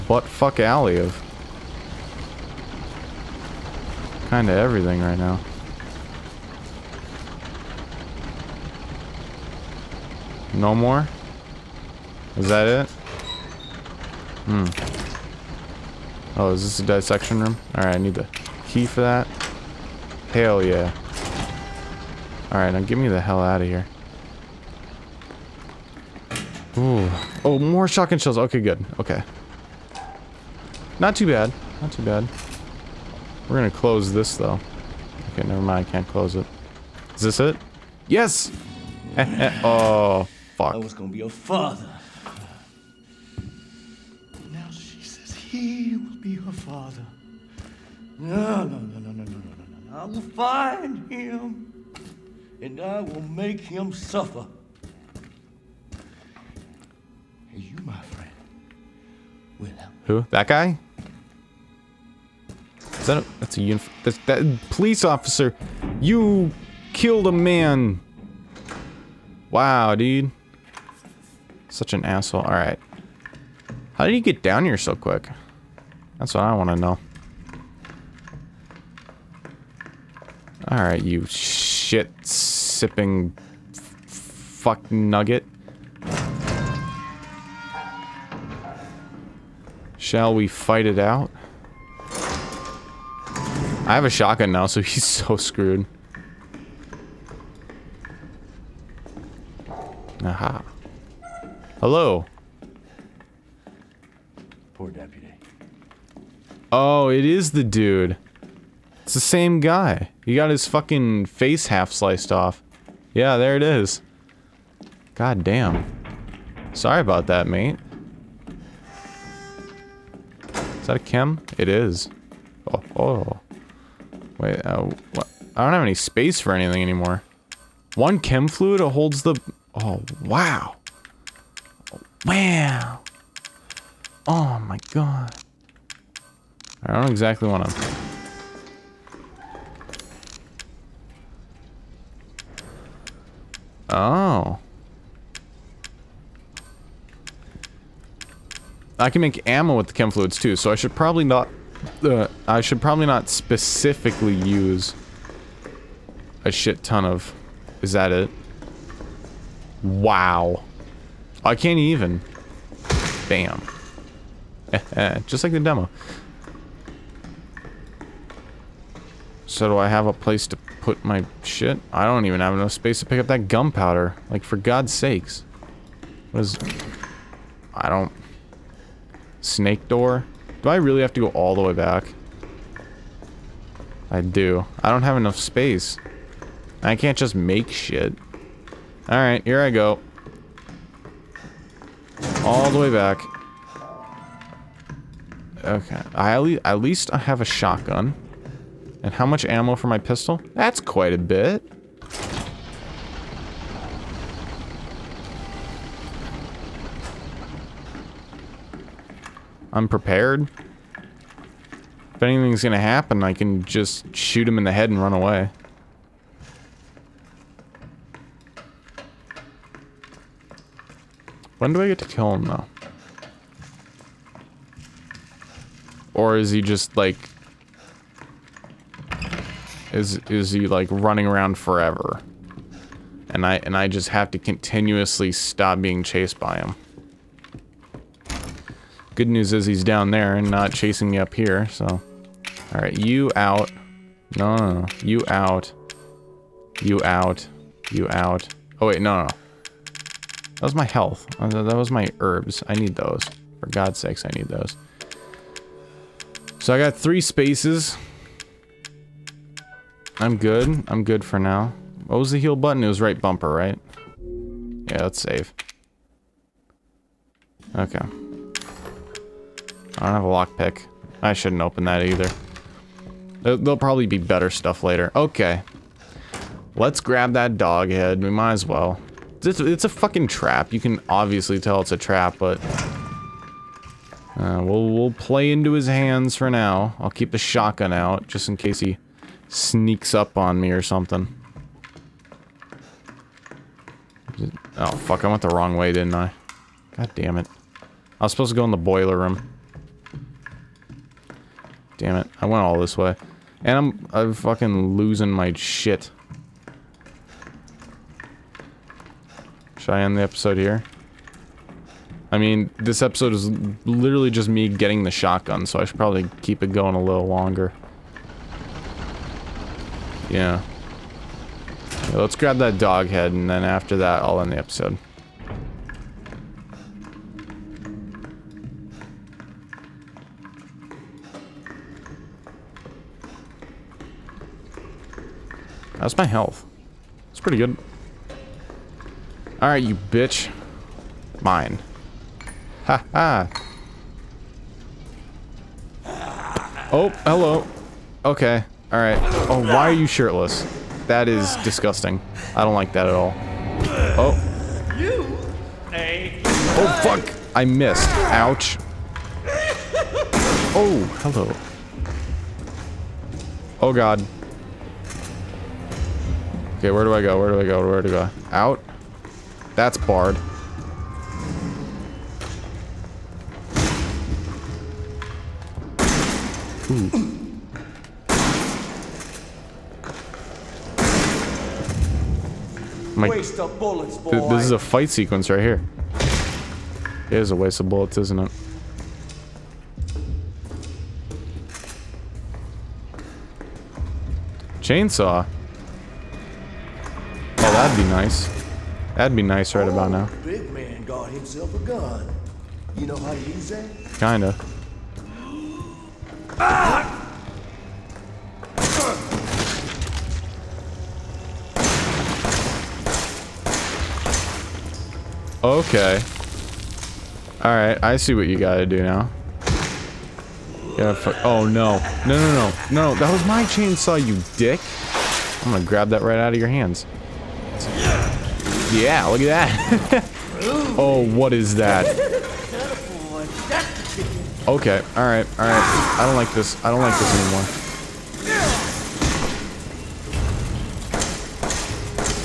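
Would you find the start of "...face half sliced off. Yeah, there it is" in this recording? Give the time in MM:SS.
01:51.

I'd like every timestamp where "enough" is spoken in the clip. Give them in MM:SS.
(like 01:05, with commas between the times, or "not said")
02:52, 03:05.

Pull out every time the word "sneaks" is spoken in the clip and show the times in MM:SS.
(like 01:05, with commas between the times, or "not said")
04:49.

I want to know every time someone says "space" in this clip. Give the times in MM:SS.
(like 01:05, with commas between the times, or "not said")
02:05, 02:52, 03:05, 04:17.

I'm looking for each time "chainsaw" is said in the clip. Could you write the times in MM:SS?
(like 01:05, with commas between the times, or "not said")
06:34, 07:03.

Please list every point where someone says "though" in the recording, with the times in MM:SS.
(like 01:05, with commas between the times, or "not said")
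00:34, 03:42.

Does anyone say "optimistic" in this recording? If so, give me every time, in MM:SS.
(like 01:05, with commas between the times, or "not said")
not said.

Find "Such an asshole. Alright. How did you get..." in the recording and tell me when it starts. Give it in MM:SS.
01:11.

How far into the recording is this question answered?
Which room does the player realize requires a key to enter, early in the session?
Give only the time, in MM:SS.
00:16.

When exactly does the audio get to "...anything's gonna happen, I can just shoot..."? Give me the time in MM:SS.
03:32.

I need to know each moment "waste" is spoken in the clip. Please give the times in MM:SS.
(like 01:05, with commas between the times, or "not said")
06:23, 06:27.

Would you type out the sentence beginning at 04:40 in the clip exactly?
You can obviously tell it's a trap, but...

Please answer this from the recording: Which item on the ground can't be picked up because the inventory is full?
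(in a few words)
Gunpowder.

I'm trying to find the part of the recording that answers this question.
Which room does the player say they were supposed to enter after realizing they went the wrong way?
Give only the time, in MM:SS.
04:58.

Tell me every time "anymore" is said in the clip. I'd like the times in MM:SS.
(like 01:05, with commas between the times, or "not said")
02:06, 07:17.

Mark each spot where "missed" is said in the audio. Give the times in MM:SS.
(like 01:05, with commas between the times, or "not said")
05:57.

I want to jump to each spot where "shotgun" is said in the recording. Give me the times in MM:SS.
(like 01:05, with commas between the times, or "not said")
00:27, 01:34, 03:17, 04:47, 05:15.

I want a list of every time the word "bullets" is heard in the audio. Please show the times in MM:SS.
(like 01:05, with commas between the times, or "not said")
06:23, 06:27.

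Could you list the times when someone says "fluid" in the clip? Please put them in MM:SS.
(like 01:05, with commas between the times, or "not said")
02:08, 02:30.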